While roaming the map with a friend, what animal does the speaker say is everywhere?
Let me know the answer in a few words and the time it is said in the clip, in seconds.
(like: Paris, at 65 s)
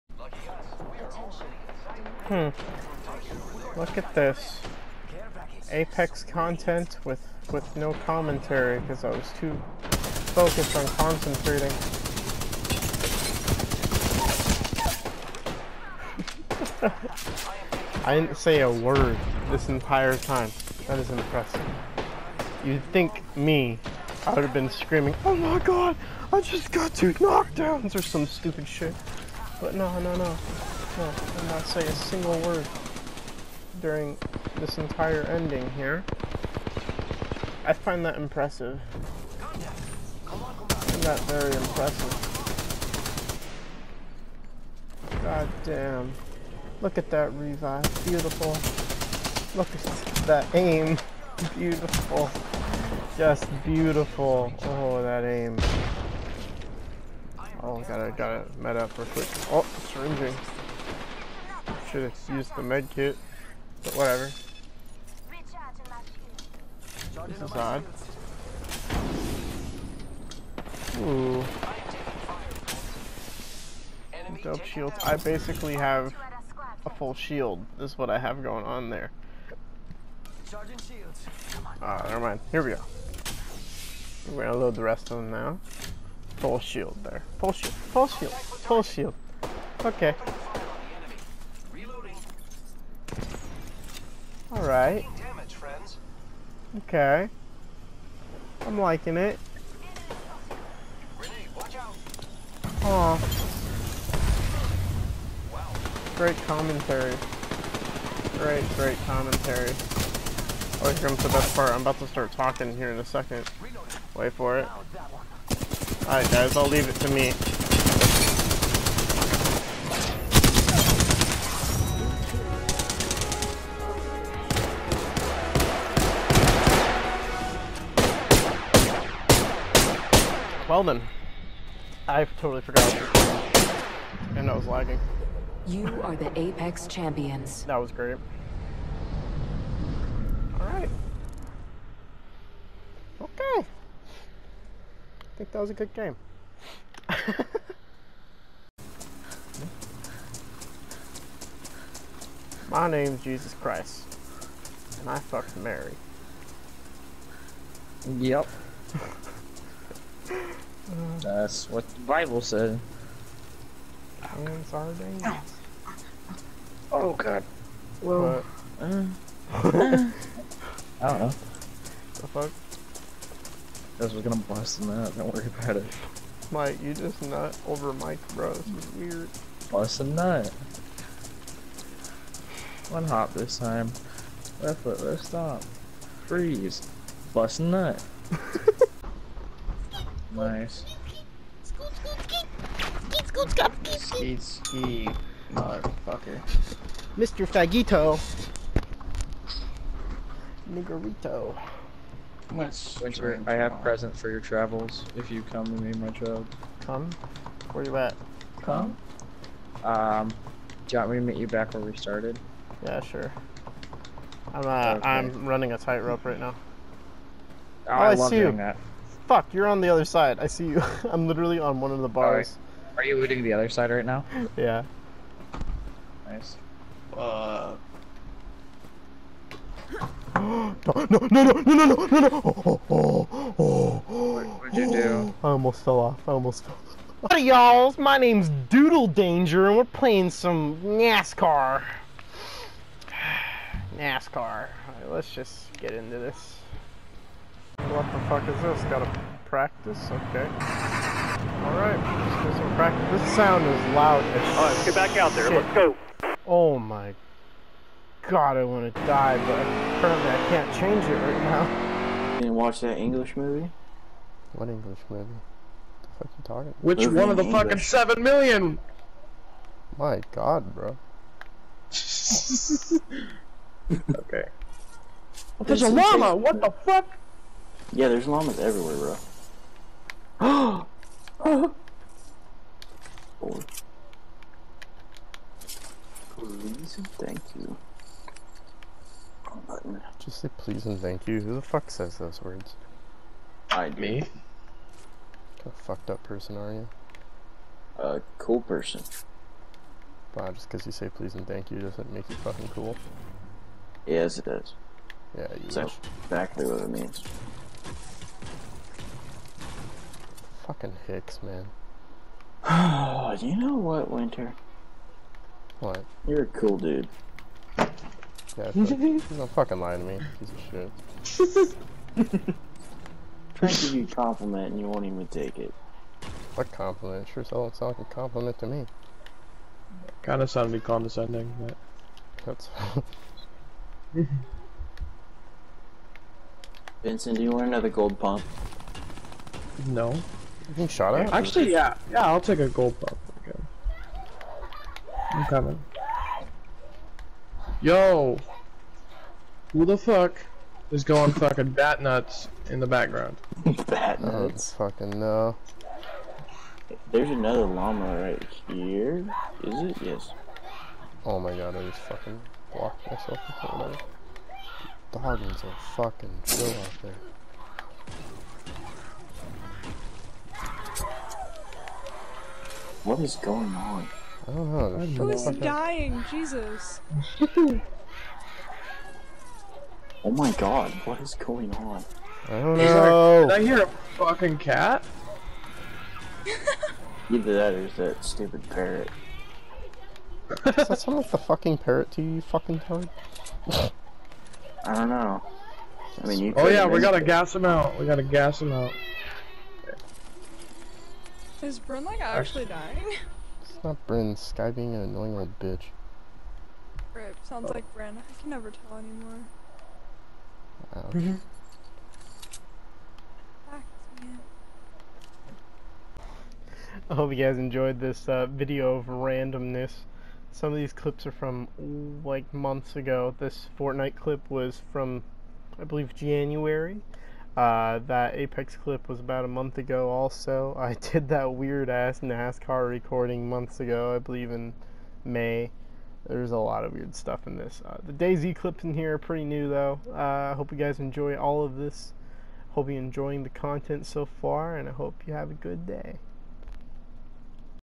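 llamas, at 278 s.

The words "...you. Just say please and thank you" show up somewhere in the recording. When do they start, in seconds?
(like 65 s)
287 s.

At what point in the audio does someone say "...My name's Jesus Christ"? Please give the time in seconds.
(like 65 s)
152 s.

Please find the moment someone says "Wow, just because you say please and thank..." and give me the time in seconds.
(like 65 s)
300 s.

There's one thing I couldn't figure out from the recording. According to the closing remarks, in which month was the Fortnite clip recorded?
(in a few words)
January.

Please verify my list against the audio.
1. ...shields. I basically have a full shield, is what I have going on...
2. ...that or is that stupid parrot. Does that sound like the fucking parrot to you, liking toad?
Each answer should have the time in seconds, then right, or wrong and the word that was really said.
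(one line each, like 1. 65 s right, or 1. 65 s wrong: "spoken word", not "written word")
1. 74 s right
2. 387 s wrong: "fucking", not "liking".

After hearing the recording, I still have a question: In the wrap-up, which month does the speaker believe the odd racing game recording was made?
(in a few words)
May.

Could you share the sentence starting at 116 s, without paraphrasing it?
Alright guys, I'll leave it to me.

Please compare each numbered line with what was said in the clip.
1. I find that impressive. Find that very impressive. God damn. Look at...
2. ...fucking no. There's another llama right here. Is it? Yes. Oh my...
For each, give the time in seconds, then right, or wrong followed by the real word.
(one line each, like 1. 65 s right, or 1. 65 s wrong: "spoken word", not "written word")
1. 37 s right
2. 354 s right.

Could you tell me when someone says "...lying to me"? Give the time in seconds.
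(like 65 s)
319 s.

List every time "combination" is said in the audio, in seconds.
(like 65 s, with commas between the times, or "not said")
not said.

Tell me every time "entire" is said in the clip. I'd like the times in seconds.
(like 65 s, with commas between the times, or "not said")
19 s, 34 s.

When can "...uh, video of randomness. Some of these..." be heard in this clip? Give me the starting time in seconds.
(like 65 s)
418 s.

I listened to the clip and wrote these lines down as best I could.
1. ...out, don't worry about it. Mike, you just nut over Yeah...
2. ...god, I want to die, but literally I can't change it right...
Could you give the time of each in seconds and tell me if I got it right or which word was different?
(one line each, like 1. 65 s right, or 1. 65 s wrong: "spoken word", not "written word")
1. 174 s wrong: "Mike", not "Yeah"
2. 258 s wrong: "apparently", not "literally".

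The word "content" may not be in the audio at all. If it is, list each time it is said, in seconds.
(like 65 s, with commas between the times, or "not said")
6 s, 443 s.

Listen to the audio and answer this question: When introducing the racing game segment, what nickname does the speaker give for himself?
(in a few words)
Doodle Danger.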